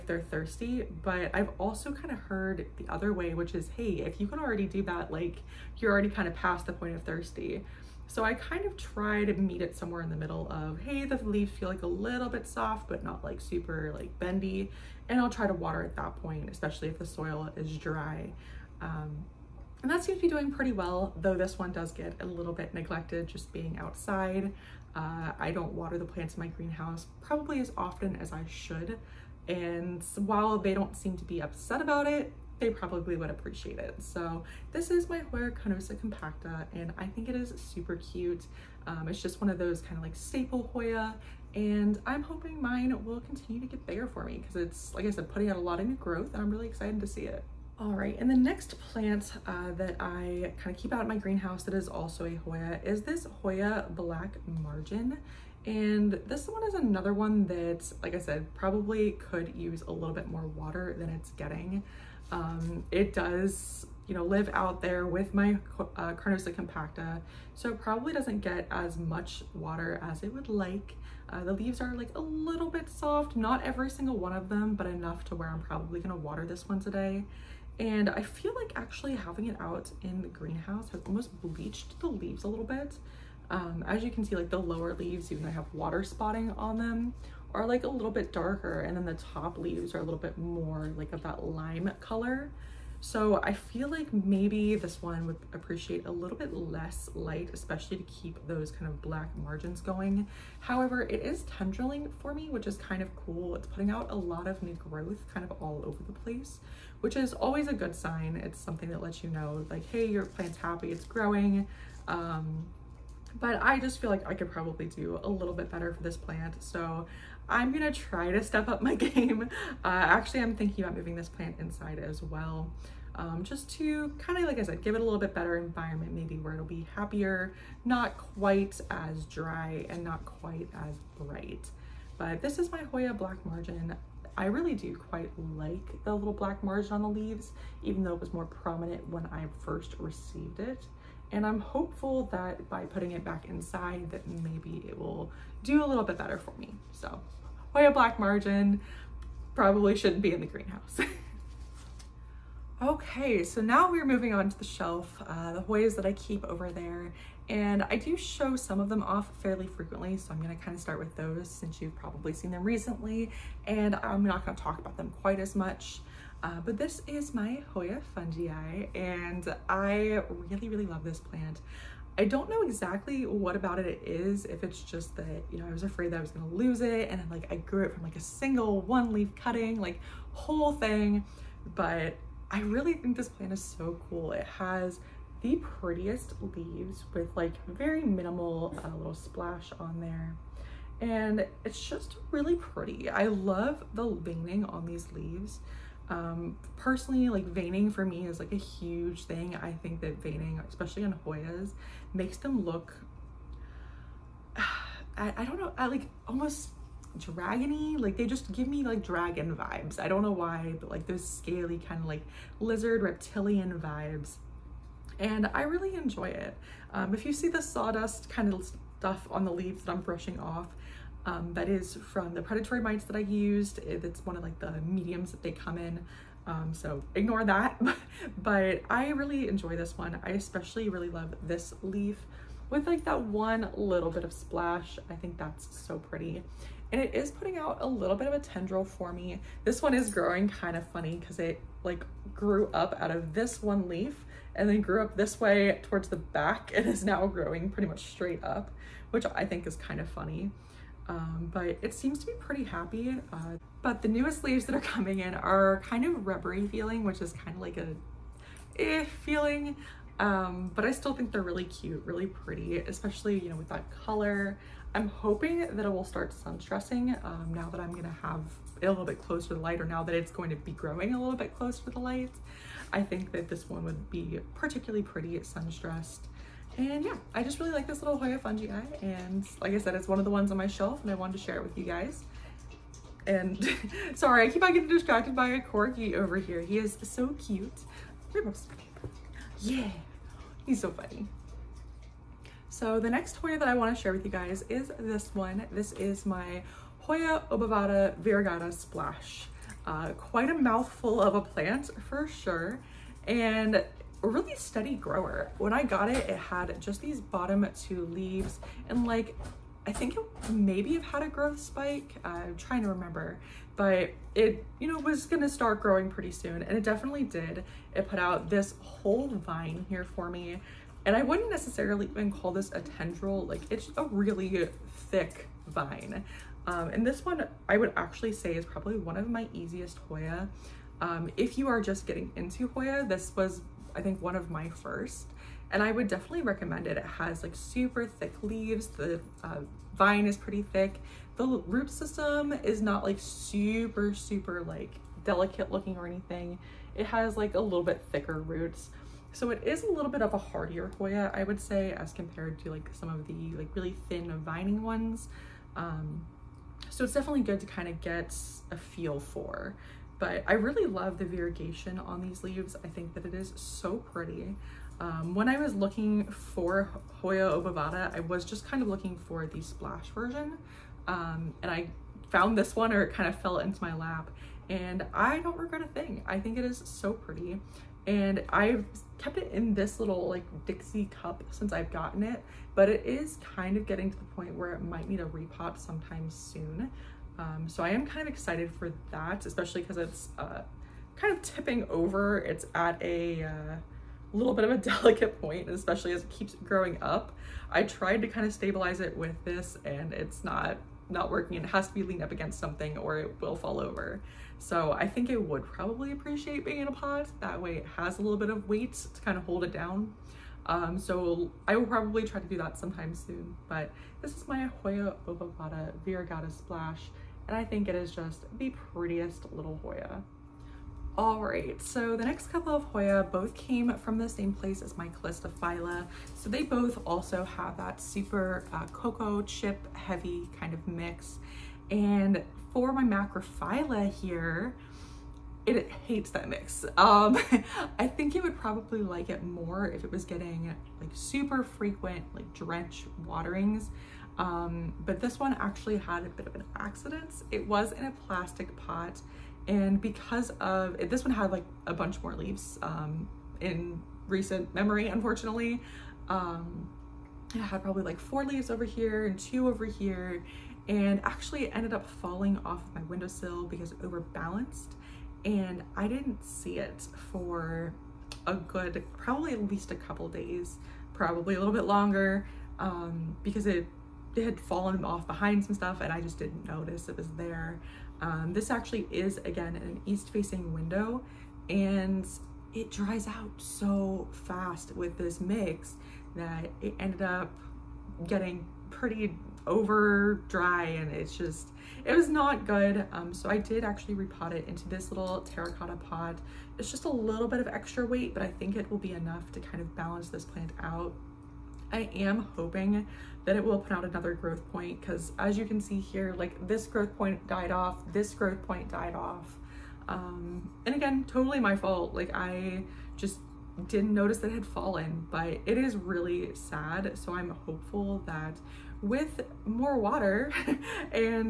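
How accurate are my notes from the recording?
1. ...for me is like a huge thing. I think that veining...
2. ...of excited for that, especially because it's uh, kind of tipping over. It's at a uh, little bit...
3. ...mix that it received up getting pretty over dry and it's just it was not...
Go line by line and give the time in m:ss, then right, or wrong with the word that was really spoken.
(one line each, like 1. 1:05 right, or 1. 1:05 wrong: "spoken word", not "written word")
1. 3:17 right
2. 6:28 right
3. 8:05 wrong: "ended", not "received".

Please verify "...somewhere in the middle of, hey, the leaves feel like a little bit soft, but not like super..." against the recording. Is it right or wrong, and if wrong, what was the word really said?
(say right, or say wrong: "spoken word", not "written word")
right.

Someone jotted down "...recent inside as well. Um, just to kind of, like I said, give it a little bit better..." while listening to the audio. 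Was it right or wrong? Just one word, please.
wrong.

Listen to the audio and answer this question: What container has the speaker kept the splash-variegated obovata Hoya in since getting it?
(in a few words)
Dixie cup.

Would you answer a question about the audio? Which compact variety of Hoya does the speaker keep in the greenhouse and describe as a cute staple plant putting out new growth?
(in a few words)
Hoya Carnosa compacta.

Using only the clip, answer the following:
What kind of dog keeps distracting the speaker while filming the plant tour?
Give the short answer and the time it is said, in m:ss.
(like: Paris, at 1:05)
Corgi, at 4:45.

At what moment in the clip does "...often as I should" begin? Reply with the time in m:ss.
0:27.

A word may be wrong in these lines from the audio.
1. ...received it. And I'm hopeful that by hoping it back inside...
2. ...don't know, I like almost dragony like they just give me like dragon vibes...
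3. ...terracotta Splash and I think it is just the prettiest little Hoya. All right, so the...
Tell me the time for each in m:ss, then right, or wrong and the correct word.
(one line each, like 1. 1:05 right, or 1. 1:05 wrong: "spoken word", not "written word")
1. 2:19 wrong: "putting", not "hoping"
2. 3:25 right
3. 6:56 wrong: "variegata", not "terracotta".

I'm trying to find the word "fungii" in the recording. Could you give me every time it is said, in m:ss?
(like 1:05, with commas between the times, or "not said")
2:48, 4:38.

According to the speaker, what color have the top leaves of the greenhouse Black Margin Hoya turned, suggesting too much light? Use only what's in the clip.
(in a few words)
lime.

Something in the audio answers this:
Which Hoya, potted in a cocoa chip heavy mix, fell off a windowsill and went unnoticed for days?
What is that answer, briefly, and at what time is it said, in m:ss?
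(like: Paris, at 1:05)
Macrophylla, at 7:13.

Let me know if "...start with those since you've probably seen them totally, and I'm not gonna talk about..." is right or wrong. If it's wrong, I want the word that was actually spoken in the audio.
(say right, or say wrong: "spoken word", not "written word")
wrong: "recently", not "totally".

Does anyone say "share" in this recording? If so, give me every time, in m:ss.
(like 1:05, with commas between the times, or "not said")
4:41, 4:54.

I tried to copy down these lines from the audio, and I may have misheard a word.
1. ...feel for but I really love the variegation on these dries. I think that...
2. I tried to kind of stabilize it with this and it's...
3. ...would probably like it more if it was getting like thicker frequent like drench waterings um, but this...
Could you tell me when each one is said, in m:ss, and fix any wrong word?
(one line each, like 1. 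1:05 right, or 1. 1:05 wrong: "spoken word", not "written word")
1. 5:58 wrong: "leaves", not "dries"
2. 6:37 right
3. 7:18 wrong: "super", not "thicker".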